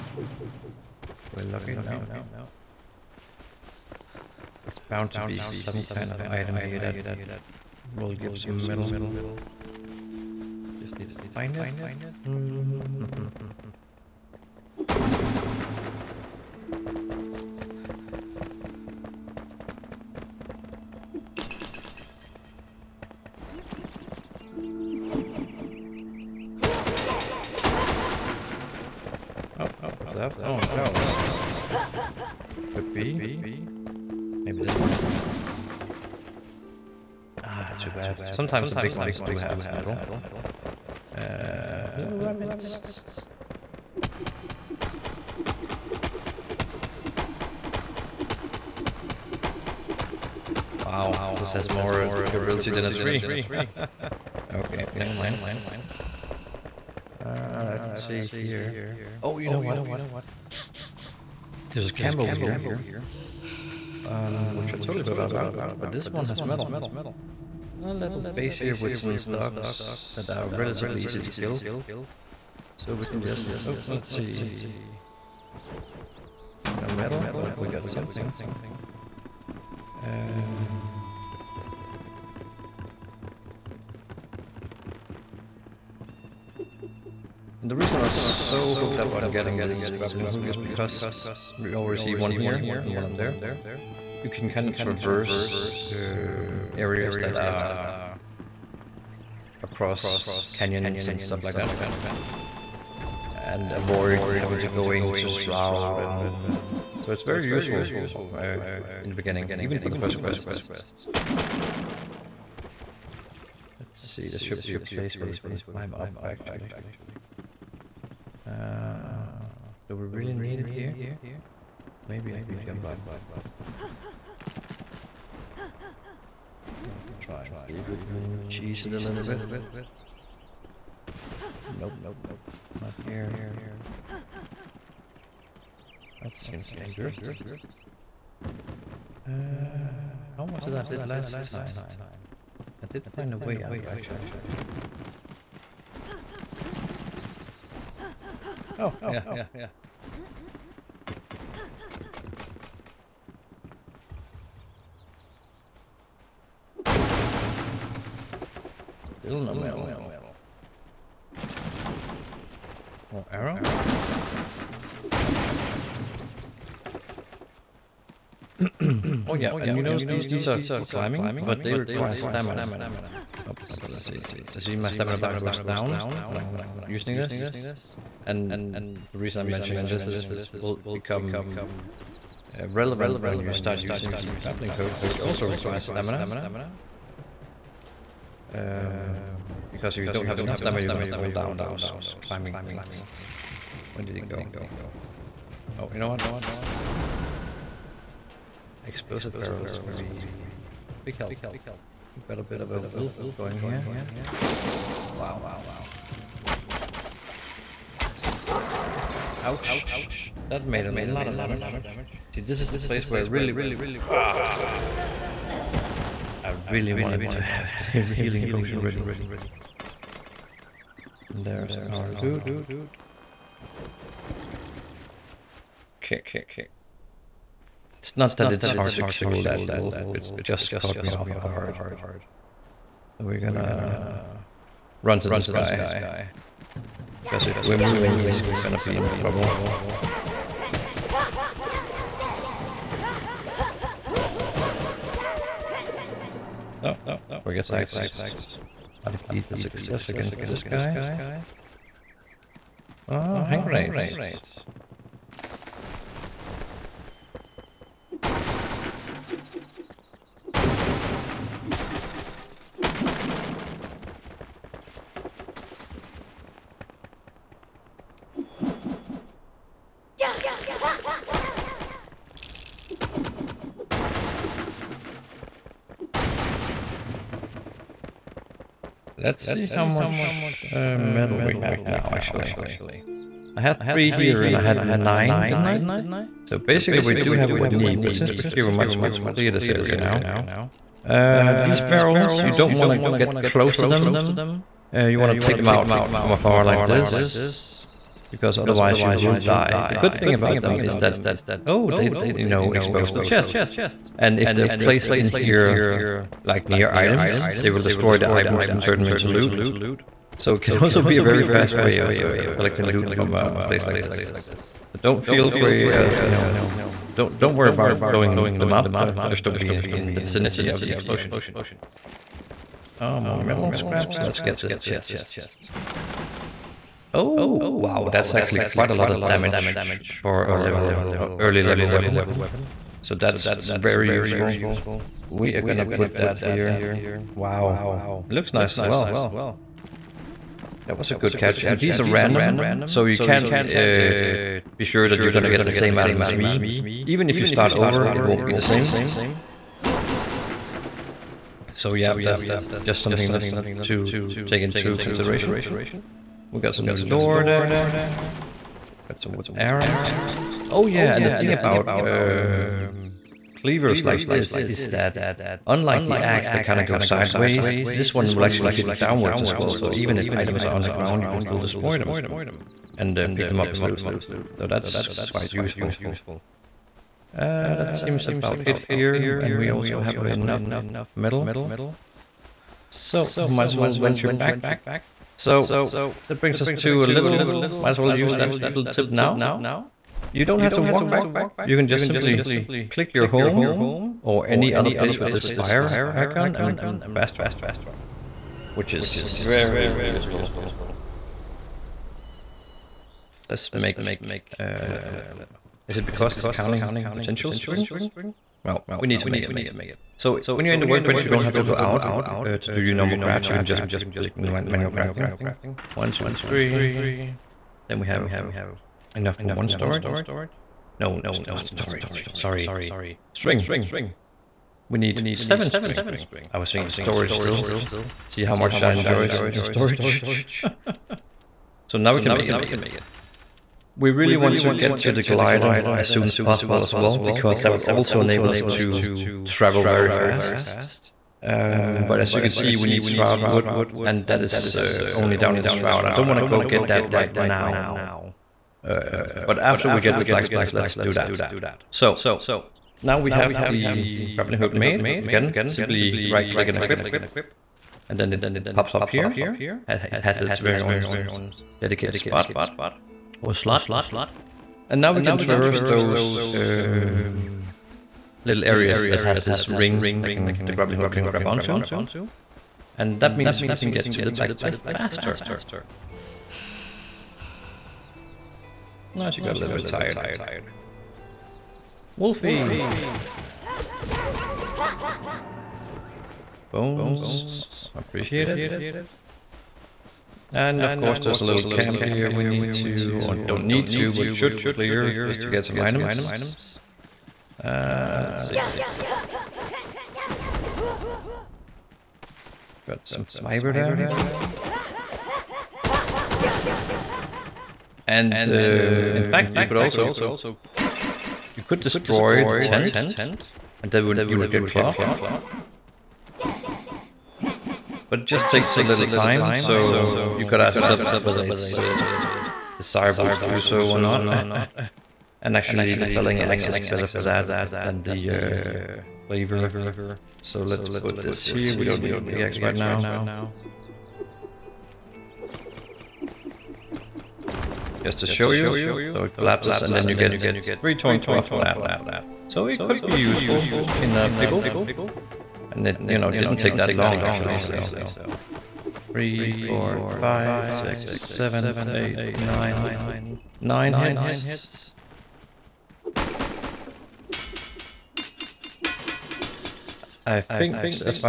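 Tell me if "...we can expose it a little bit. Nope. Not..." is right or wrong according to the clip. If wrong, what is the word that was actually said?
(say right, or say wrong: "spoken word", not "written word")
wrong: "cheese", not "expose".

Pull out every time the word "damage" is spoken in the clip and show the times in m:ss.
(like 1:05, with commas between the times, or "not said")
3:31, 5:29.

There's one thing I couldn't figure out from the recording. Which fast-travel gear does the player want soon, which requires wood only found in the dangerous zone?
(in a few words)
The glider.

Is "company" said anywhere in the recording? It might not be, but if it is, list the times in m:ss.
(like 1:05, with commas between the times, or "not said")
not said.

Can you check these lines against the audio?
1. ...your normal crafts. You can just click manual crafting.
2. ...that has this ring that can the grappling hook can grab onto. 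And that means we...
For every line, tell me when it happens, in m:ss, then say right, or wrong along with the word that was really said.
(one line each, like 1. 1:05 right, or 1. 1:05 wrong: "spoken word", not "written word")
1. 6:52 right
2. 7:49 right.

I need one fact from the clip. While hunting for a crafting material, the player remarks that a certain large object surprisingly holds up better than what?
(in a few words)
A tree.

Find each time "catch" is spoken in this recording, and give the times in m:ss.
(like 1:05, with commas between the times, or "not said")
5:41.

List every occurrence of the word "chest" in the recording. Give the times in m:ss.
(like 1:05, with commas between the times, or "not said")
5:03, 5:24.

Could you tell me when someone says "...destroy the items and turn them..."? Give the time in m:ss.
5:07.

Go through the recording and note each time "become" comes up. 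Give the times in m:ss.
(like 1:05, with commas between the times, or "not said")
3:00.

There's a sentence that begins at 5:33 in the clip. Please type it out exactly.
So that's very useful we are gonna put that here.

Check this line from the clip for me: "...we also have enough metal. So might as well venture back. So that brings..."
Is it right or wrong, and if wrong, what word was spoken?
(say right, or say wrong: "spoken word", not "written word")
right.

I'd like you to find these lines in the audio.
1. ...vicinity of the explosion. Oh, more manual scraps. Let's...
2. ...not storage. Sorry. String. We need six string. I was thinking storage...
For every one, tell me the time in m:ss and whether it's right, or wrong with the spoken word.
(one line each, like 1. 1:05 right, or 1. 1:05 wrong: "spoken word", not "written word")
1. 5:20 wrong: "metal", not "manual"
2. 7:01 wrong: "seven", not "six".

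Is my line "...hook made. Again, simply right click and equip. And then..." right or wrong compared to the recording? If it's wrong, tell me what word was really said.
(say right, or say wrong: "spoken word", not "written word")
right.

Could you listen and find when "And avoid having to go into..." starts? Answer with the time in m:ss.
1:43.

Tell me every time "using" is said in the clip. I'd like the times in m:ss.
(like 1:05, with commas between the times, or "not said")
2:56, 3:03.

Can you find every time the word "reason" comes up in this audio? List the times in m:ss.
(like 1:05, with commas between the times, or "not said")
1:27, 2:59.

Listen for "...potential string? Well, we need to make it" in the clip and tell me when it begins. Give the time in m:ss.
6:47.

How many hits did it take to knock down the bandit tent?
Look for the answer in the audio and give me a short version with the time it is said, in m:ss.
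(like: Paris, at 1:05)
9, at 9:13.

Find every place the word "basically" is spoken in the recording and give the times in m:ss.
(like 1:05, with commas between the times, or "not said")
4:46.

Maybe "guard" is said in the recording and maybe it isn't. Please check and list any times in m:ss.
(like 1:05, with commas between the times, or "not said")
3:51.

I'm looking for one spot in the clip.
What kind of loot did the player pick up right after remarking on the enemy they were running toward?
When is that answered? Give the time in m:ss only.
4:13.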